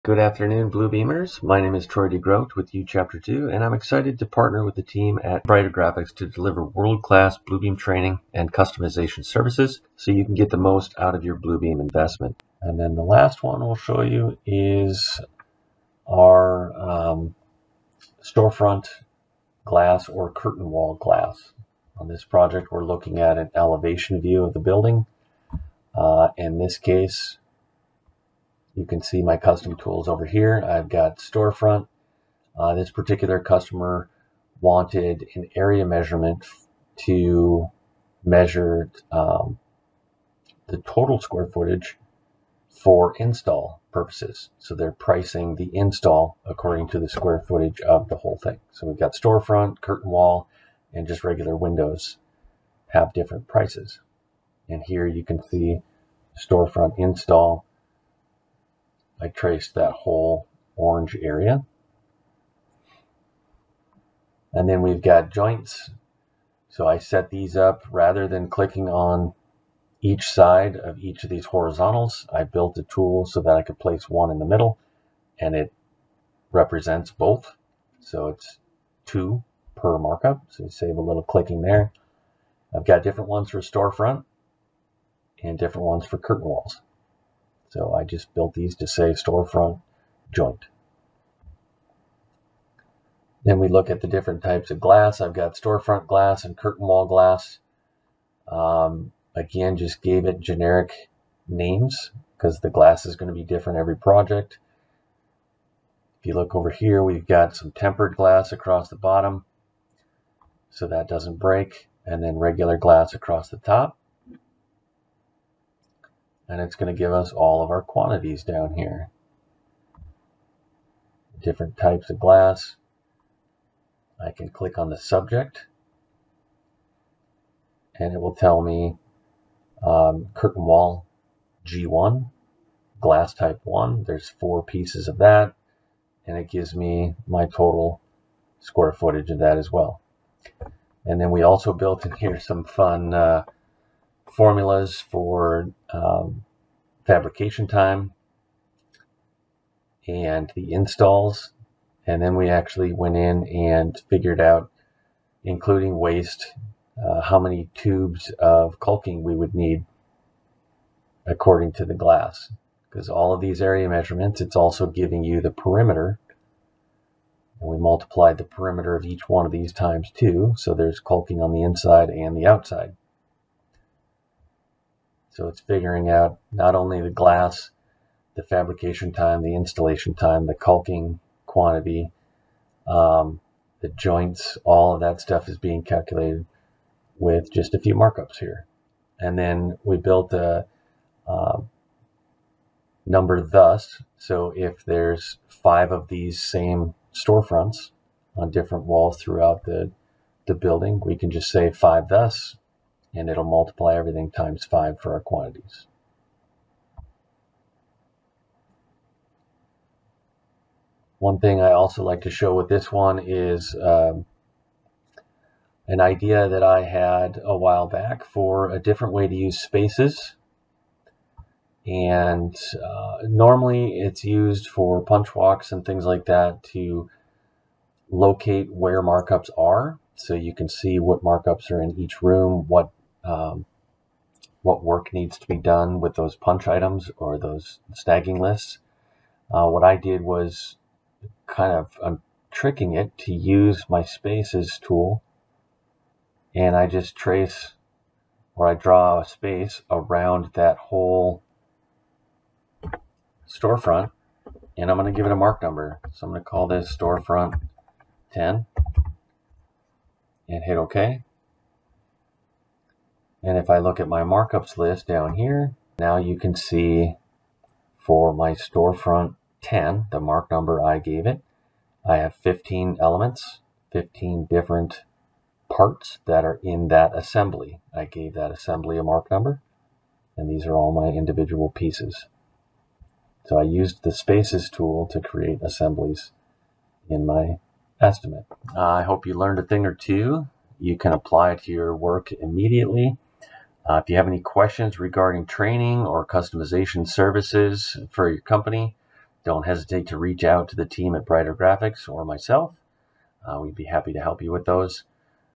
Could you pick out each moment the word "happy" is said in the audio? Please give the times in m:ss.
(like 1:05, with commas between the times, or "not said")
5:03.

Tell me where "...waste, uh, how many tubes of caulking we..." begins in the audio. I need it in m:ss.
2:35.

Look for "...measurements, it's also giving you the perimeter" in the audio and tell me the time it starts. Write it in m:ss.
2:43.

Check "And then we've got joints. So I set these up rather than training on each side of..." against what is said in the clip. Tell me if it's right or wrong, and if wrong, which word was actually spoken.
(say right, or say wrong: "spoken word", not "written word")
wrong: "clicking", not "training".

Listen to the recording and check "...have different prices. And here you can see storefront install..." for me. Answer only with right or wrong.
right.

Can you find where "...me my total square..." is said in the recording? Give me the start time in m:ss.
2:16.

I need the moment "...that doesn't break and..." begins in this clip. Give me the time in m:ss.
1:50.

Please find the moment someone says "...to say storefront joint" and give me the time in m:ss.
1:28.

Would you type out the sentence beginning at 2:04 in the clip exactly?
I can click on the subject and it will tell me um, wall G1, glass type 1.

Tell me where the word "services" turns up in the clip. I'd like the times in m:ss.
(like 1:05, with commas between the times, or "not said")
0:09, 4:57.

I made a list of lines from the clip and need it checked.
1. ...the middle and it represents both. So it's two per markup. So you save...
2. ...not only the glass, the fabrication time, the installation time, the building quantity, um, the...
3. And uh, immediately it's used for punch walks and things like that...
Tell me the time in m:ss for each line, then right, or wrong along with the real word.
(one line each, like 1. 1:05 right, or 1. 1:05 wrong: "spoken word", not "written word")
1. 1:14 right
2. 2:56 wrong: "caulking", not "building"
3. 3:41 wrong: "normally", not "immediately".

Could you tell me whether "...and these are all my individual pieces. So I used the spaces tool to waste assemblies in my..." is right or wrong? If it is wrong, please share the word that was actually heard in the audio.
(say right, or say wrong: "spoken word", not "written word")
wrong: "create", not "waste".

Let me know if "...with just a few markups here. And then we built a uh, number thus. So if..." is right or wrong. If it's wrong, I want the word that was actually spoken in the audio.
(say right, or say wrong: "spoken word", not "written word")
right.